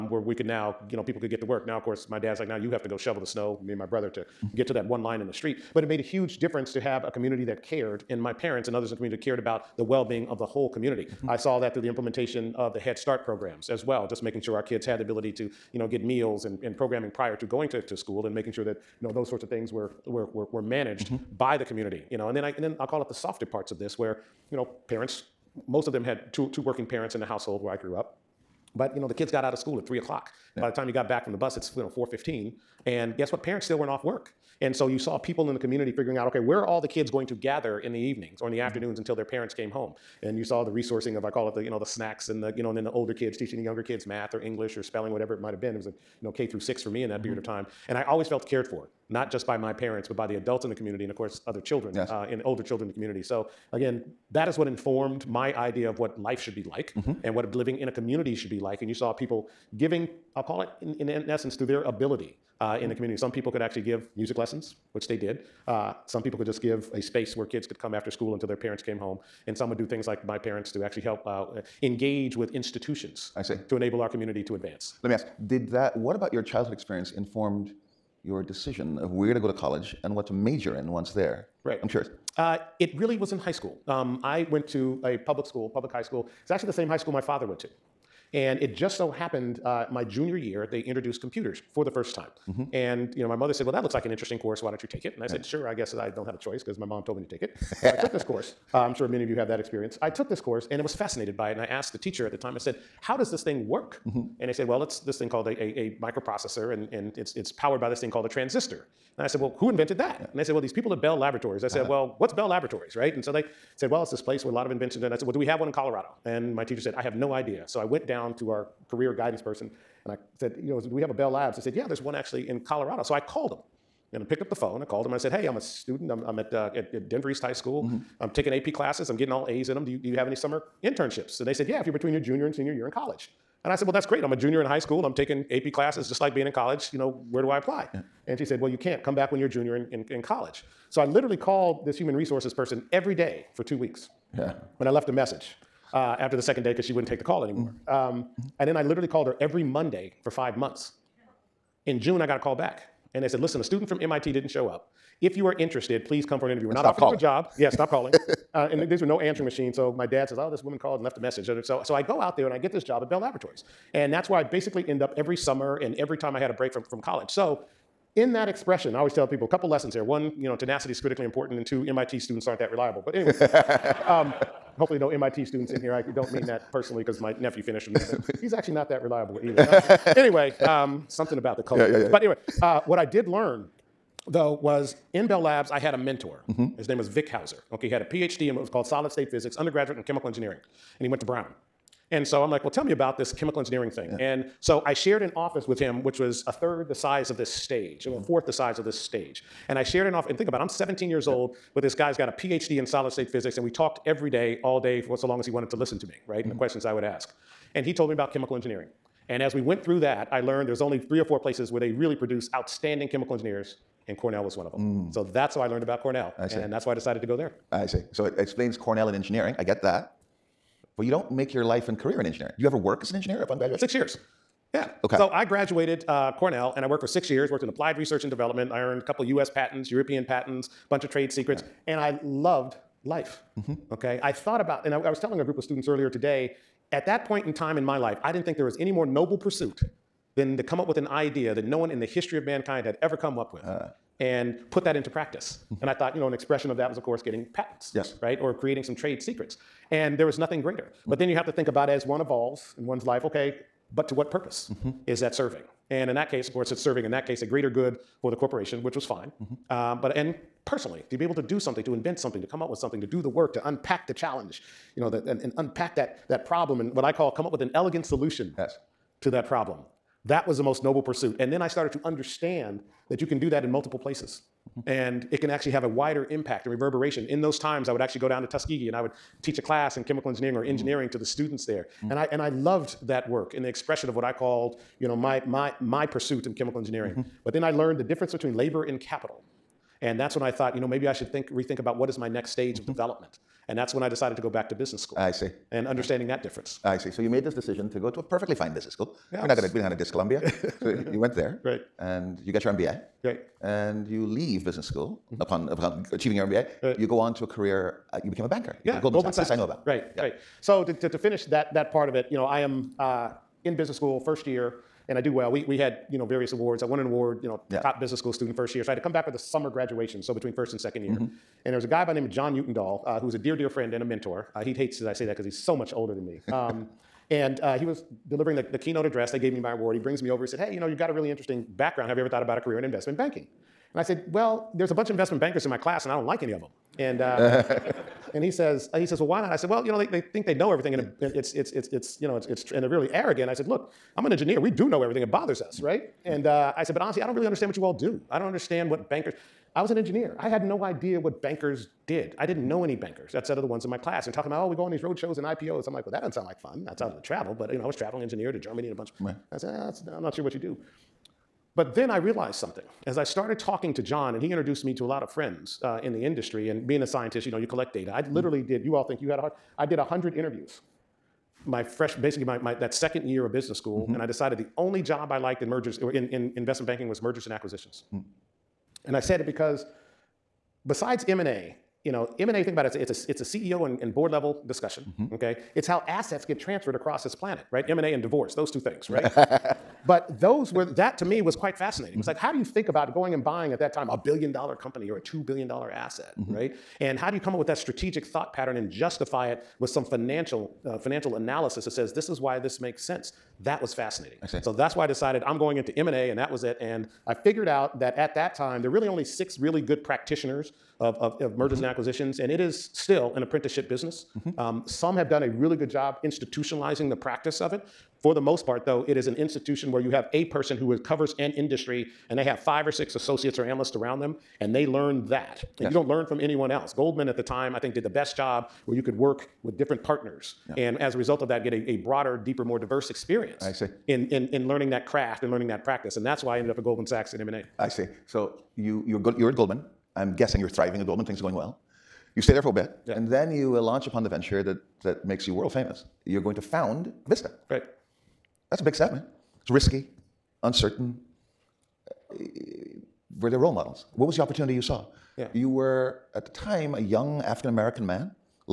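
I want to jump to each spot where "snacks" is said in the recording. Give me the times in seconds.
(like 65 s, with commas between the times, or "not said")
41 s.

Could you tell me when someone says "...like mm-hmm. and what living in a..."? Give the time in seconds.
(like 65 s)
56 s.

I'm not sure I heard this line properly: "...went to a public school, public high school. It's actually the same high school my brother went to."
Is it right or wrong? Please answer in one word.
wrong.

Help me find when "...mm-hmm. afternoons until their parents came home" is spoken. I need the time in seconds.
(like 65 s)
38 s.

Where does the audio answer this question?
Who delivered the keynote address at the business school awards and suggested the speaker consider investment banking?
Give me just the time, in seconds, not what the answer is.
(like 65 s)
322 s.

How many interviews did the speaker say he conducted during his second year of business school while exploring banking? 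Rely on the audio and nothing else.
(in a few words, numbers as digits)
100.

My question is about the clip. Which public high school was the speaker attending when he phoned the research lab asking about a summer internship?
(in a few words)
Denver East High School.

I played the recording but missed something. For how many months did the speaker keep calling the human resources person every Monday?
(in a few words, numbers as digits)
5.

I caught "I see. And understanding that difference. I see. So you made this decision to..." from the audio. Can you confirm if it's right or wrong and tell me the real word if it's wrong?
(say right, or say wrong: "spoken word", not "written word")
right.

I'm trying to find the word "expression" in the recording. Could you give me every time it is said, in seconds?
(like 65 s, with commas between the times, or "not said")
168 s, 246 s, 283 s.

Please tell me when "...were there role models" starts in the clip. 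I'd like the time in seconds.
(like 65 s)
453 s.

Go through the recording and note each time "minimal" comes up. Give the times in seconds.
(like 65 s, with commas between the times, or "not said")
not said.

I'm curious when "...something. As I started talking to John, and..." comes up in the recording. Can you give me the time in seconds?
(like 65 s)
362 s.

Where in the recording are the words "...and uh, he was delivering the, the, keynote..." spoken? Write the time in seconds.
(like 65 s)
327 s.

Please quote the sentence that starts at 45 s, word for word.
It was a, you know, K through six for me in that mm-hmm.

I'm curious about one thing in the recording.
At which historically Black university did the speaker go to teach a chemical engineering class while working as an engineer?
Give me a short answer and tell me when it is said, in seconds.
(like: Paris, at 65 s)
Tuskegee, at 278 s.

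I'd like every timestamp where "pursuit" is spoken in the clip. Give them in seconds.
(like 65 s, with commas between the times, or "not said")
239 s, 271 s, 286 s.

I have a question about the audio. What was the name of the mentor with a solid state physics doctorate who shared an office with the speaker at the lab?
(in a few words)
Vic Hauser.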